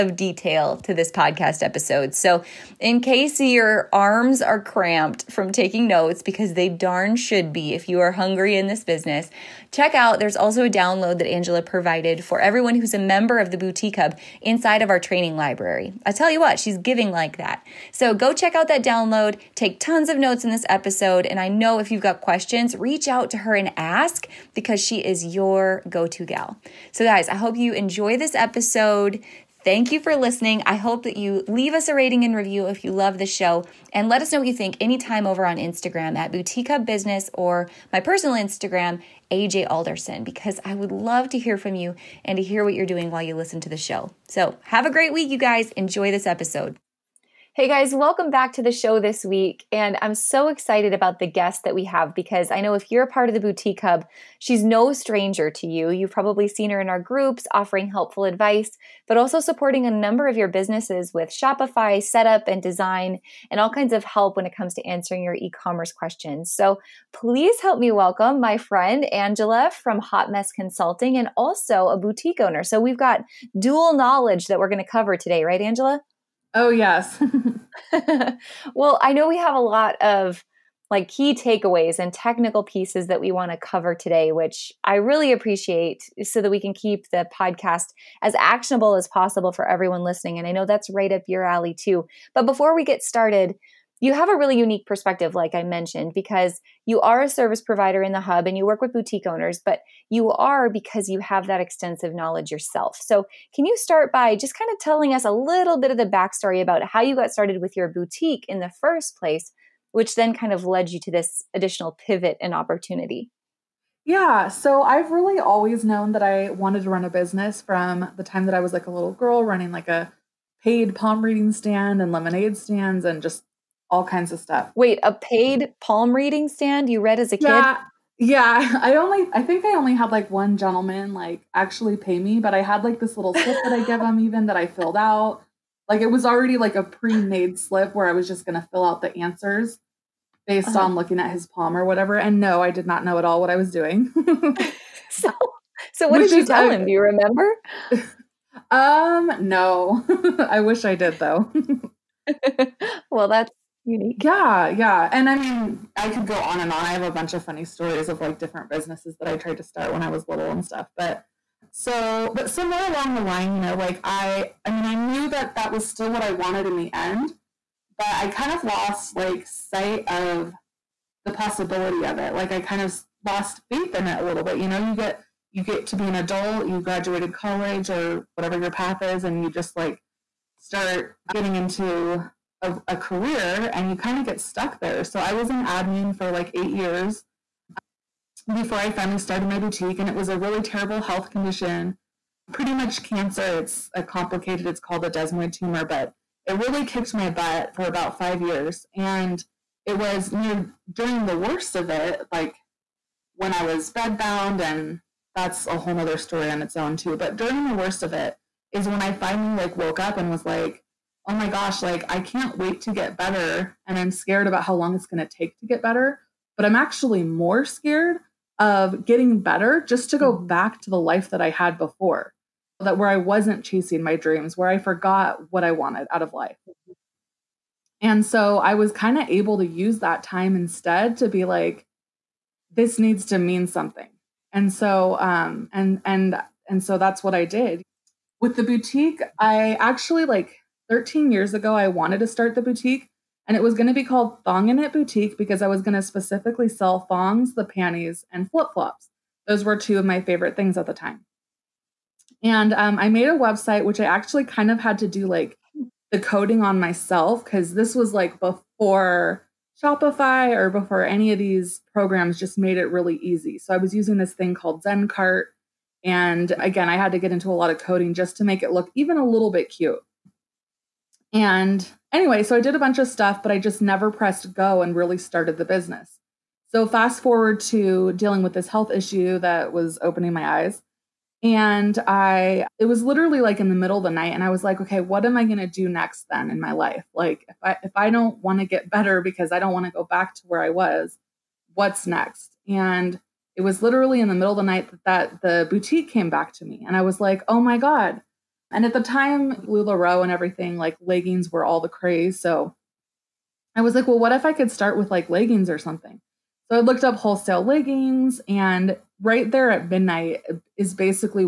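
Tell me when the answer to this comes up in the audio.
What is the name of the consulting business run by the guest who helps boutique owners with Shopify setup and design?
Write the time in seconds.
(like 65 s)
70 s.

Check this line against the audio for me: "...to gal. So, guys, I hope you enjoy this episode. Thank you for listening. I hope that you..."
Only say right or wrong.
right.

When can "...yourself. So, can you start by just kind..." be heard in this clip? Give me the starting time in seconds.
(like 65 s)
102 s.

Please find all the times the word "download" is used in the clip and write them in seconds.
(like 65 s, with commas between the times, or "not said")
10 s, 18 s.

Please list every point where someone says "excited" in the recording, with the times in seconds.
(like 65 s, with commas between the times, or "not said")
50 s.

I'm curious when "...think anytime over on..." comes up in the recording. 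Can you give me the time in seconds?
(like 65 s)
34 s.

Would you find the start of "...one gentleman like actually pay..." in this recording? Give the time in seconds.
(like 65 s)
130 s.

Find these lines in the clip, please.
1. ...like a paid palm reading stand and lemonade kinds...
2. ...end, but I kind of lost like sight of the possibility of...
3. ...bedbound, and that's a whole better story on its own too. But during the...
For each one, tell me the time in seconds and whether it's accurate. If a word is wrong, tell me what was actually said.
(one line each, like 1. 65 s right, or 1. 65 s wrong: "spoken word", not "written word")
1. 119 s wrong: "stands", not "kinds"
2. 166 s right
3. 203 s wrong: "nother", not "better".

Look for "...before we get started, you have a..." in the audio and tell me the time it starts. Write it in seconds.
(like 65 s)
92 s.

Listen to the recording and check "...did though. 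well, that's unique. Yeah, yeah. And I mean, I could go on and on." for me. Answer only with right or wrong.
right.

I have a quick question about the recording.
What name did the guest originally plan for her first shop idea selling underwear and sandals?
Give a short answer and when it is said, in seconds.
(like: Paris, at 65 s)
Thong In It Boutique, at 244 s.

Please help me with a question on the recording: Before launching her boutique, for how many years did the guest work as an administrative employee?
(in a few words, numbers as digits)
8.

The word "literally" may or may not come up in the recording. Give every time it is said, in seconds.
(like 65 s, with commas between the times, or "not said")
283 s, 293 s.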